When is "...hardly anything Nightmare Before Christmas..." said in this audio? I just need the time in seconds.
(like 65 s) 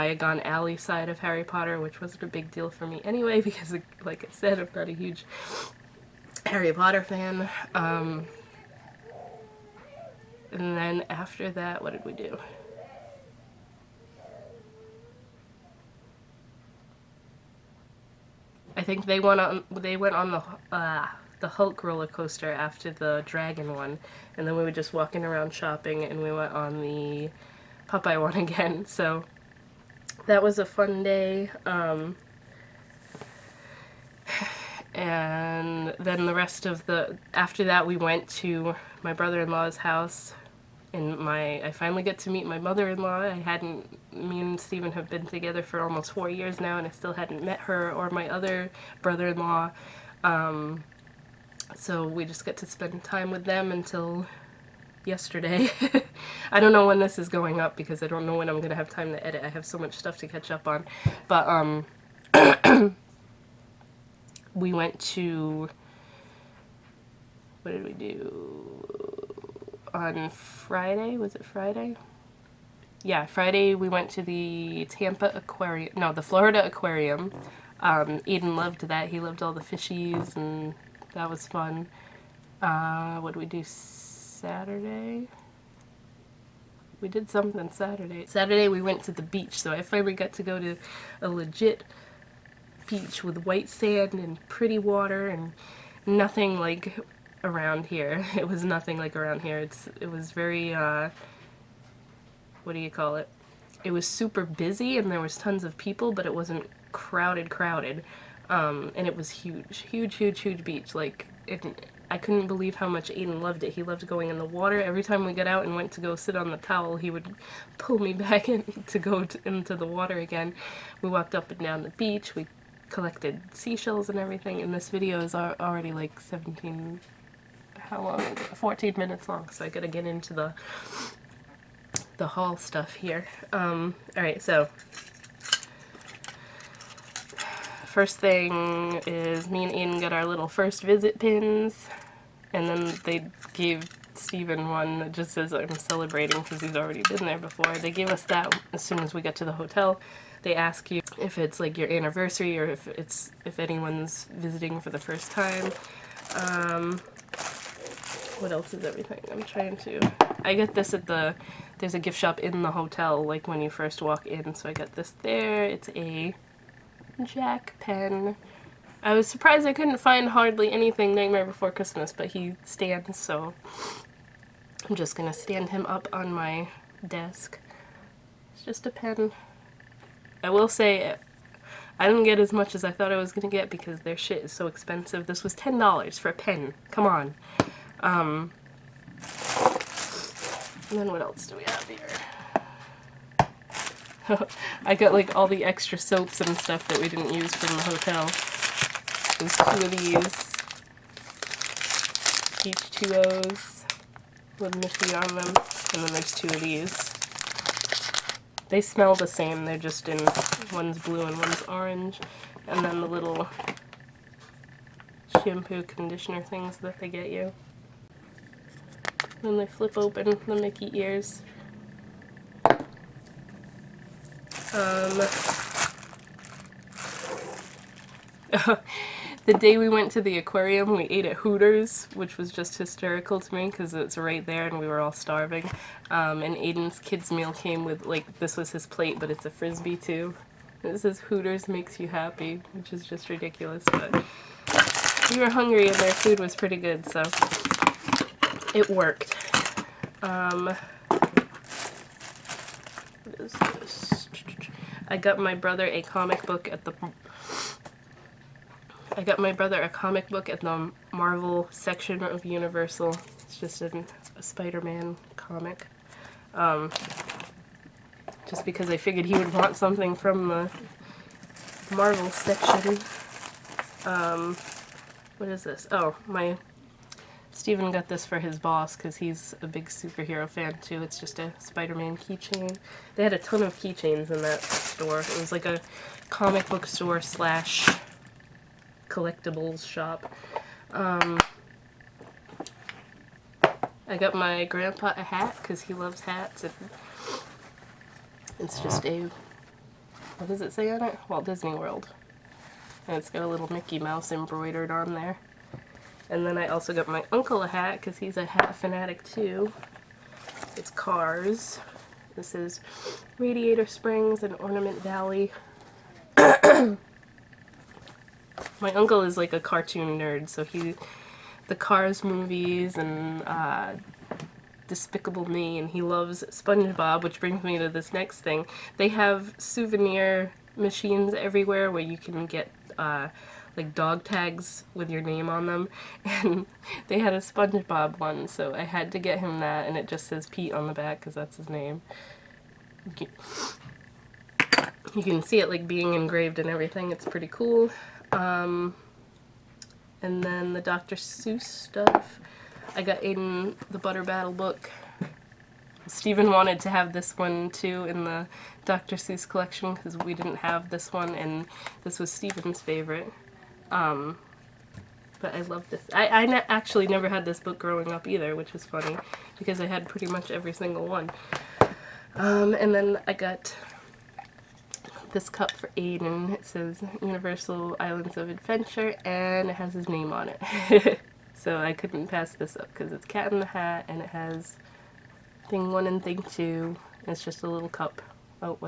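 170 s.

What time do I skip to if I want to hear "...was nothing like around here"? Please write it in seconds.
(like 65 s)
98 s.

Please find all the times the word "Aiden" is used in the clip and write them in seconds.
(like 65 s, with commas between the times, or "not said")
113 s, 236 s, 353 s, 375 s.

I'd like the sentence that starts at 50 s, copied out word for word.
Um, so we just get to spend time with them until yesterday.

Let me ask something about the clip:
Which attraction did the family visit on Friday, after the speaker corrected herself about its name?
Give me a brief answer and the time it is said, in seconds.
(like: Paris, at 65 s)
Florida Aquarium, at 76 s.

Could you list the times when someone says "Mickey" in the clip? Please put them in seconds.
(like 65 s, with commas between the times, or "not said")
220 s, 303 s.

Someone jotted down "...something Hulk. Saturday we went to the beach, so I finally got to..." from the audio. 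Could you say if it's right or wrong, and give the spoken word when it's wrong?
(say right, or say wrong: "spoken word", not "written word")
wrong: "Saturday", not "Hulk".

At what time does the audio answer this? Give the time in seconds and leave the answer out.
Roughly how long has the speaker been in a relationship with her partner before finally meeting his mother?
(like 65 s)
45 s.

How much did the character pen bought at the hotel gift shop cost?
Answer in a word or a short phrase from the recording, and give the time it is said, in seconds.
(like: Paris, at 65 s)
$10, at 185 s.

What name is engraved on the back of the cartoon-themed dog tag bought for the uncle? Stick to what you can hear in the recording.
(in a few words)
Pete.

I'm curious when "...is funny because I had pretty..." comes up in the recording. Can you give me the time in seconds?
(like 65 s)
368 s.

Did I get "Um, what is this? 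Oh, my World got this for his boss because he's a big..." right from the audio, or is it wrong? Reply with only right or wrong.
wrong.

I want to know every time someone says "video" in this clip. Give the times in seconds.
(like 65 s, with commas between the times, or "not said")
124 s.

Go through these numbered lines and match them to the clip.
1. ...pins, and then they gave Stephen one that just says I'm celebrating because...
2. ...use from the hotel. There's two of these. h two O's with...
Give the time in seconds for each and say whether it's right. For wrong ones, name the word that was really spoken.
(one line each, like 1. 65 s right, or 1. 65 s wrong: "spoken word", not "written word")
1. 141 s right
2. 197 s right.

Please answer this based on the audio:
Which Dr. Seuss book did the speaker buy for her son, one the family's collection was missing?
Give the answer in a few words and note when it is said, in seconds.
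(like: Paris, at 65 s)
The Butter Battle Book, at 353 s.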